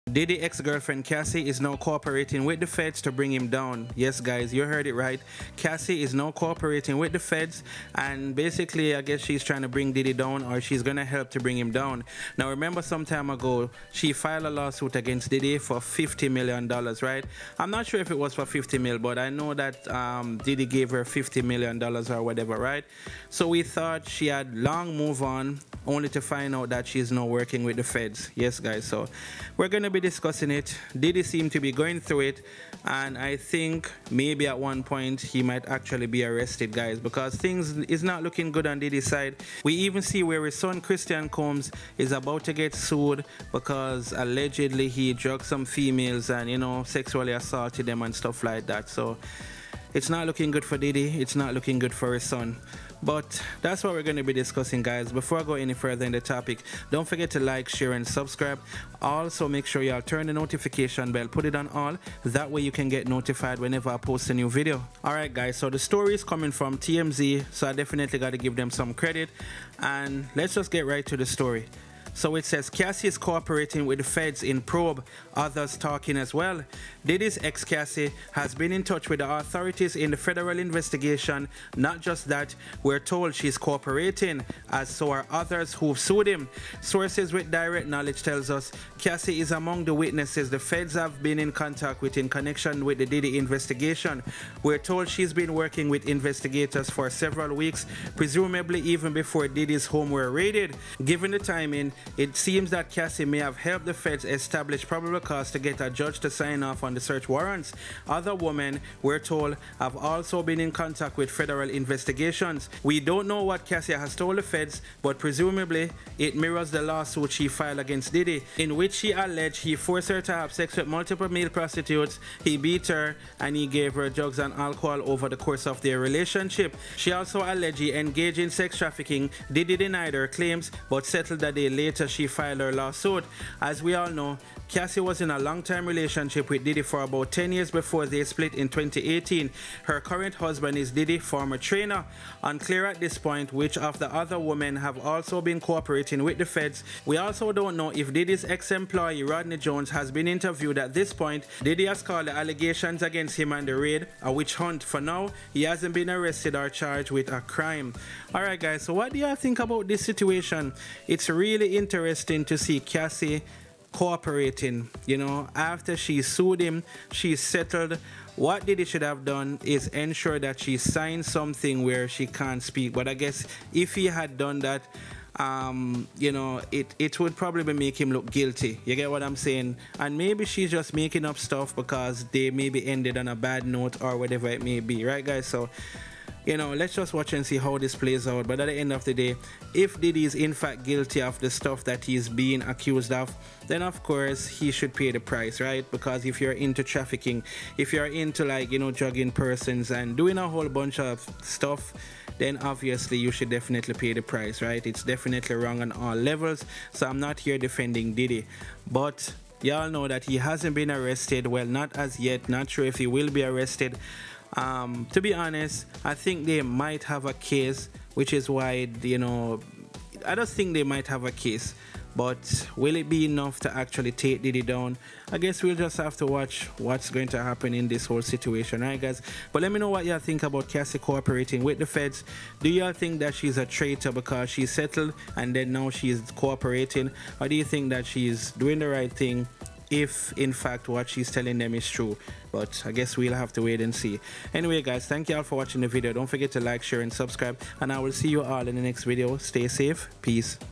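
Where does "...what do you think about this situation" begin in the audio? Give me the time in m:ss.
2:38.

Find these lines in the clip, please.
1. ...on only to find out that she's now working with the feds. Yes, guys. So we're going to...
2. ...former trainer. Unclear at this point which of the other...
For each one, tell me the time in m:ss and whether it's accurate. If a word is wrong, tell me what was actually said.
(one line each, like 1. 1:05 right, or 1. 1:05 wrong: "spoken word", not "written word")
1. 0:25 right
2. 2:21 right.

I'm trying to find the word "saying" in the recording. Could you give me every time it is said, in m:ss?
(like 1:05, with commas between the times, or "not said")
2:59.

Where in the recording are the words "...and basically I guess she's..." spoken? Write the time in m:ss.
0:07.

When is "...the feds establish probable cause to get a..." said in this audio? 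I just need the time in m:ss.
1:43.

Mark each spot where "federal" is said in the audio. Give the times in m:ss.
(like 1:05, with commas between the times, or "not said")
1:20, 1:51.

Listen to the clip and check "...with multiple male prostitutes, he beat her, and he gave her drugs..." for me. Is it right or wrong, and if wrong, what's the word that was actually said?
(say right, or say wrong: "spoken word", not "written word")
right.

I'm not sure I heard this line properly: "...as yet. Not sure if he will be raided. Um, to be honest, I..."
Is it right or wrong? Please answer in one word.
wrong.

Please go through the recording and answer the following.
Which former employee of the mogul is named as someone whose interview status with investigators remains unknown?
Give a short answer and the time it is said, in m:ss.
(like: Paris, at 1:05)
Rodney Jones, at 2:29.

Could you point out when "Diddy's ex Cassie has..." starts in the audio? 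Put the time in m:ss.
1:17.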